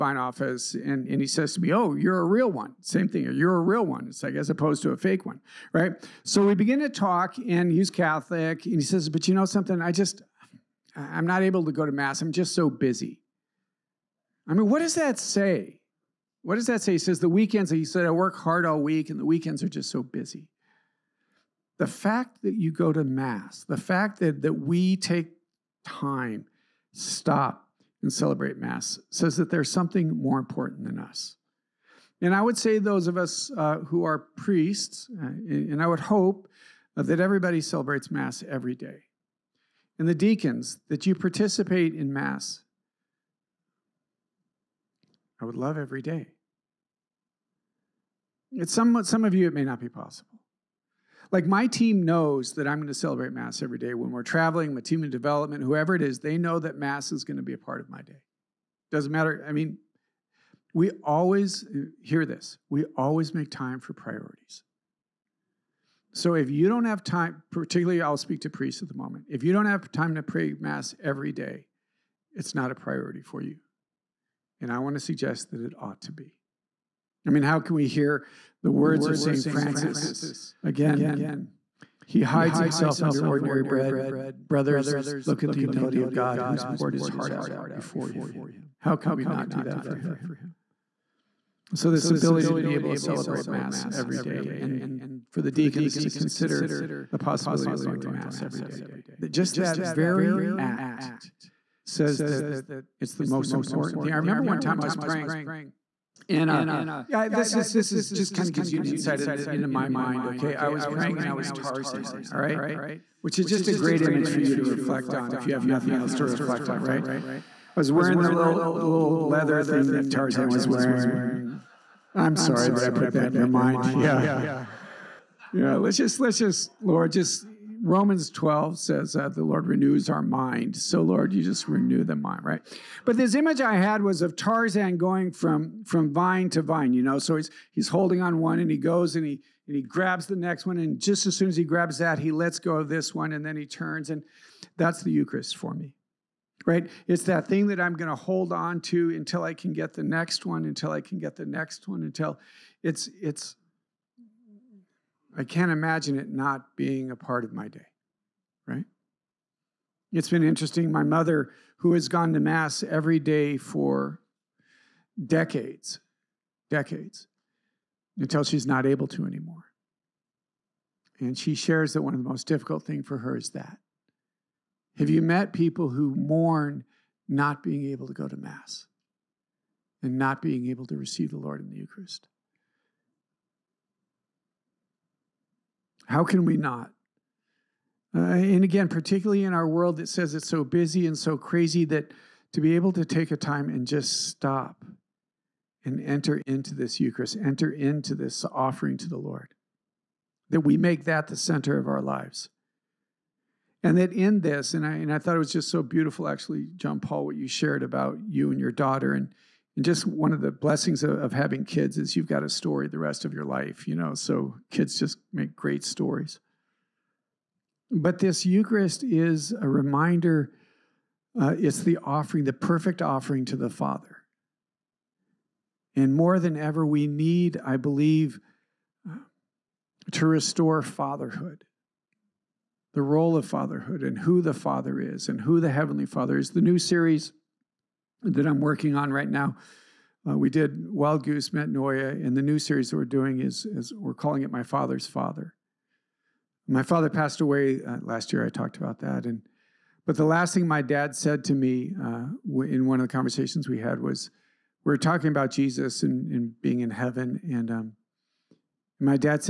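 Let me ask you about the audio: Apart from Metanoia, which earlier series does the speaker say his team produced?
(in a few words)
Wild Goose.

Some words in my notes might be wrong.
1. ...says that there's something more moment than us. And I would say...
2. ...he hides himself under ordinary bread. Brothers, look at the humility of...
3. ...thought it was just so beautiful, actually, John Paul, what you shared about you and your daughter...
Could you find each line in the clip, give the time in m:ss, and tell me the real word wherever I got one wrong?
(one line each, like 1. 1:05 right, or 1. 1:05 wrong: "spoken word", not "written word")
1. 0:29 wrong: "important", not "moment"
2. 1:22 right
3. 3:25 right.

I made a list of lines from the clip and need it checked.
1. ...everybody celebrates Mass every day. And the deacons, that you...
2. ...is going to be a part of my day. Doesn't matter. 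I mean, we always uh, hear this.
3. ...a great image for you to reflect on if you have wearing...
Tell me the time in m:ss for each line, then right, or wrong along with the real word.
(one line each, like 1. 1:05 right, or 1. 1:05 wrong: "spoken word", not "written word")
1. 0:37 right
2. 0:57 right
3. 1:53 wrong: "nothing", not "wearing".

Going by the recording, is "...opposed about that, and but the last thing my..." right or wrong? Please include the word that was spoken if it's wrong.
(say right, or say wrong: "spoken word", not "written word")
wrong: "talked", not "opposed".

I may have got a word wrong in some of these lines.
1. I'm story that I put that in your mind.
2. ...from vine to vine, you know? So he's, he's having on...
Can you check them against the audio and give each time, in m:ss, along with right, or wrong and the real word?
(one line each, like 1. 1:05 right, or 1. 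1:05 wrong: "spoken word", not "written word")
1. 2:02 wrong: "sorry", not "story"
2. 2:15 wrong: "holding", not "having".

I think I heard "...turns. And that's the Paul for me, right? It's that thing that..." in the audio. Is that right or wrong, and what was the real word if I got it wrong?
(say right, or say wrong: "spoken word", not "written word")
wrong: "Eucharist", not "Paul".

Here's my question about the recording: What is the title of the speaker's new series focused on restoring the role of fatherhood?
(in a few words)
My Father's Father.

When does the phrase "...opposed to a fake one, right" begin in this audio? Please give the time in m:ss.
0:04.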